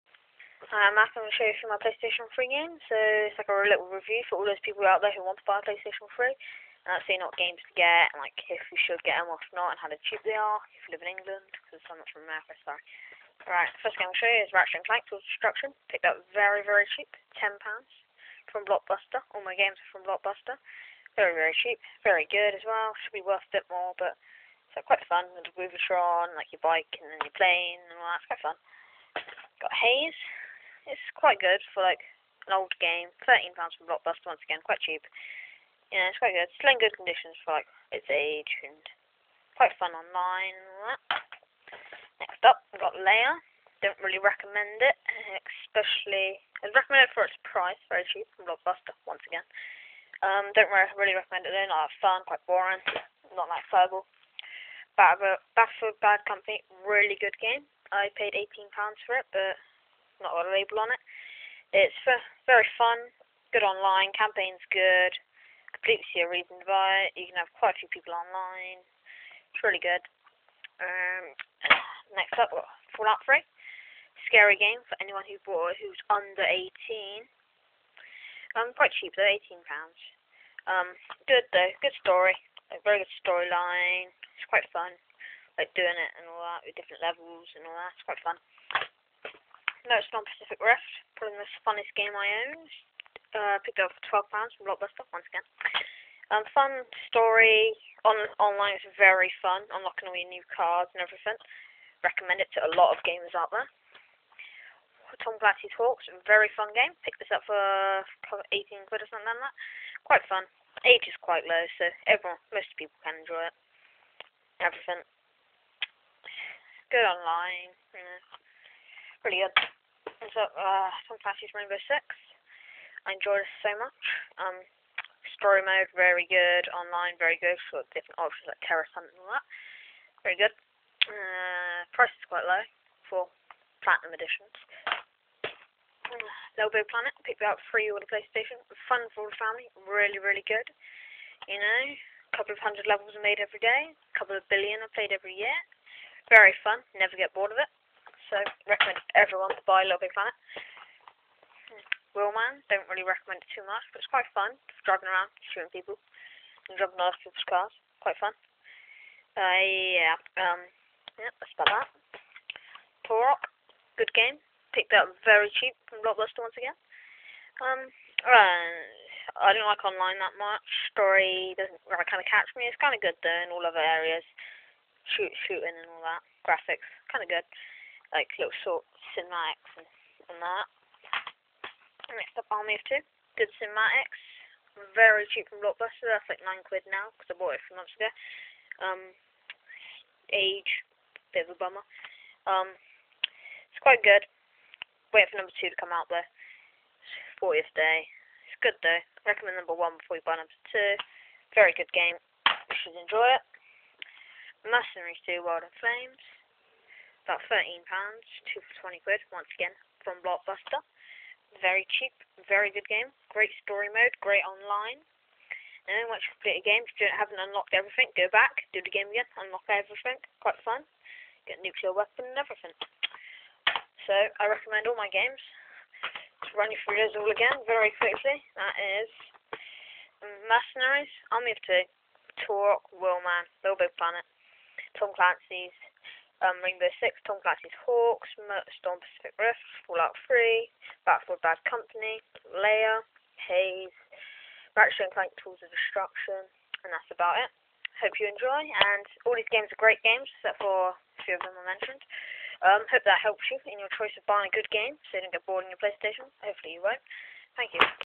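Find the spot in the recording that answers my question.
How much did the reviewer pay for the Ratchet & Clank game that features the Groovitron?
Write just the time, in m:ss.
0:17.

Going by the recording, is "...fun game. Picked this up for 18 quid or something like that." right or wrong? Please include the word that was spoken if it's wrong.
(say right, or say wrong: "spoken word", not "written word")
right.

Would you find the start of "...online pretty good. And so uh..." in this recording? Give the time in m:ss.
1:57.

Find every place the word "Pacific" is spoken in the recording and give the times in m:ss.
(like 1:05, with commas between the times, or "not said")
1:30, 3:59.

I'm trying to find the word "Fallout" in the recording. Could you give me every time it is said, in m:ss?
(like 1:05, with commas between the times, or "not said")
1:12, 3:59.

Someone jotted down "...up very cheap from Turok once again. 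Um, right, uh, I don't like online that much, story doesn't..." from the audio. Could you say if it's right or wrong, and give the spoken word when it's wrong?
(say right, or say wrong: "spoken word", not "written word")
wrong: "Blockbuster", not "Turok".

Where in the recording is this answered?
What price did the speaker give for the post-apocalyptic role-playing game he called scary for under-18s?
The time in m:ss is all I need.
1:19.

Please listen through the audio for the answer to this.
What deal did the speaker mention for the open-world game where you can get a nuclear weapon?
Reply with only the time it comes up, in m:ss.
3:28.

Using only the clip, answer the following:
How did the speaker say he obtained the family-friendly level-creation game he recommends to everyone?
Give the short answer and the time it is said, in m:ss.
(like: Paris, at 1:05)
free on the PlayStation, at 2:17.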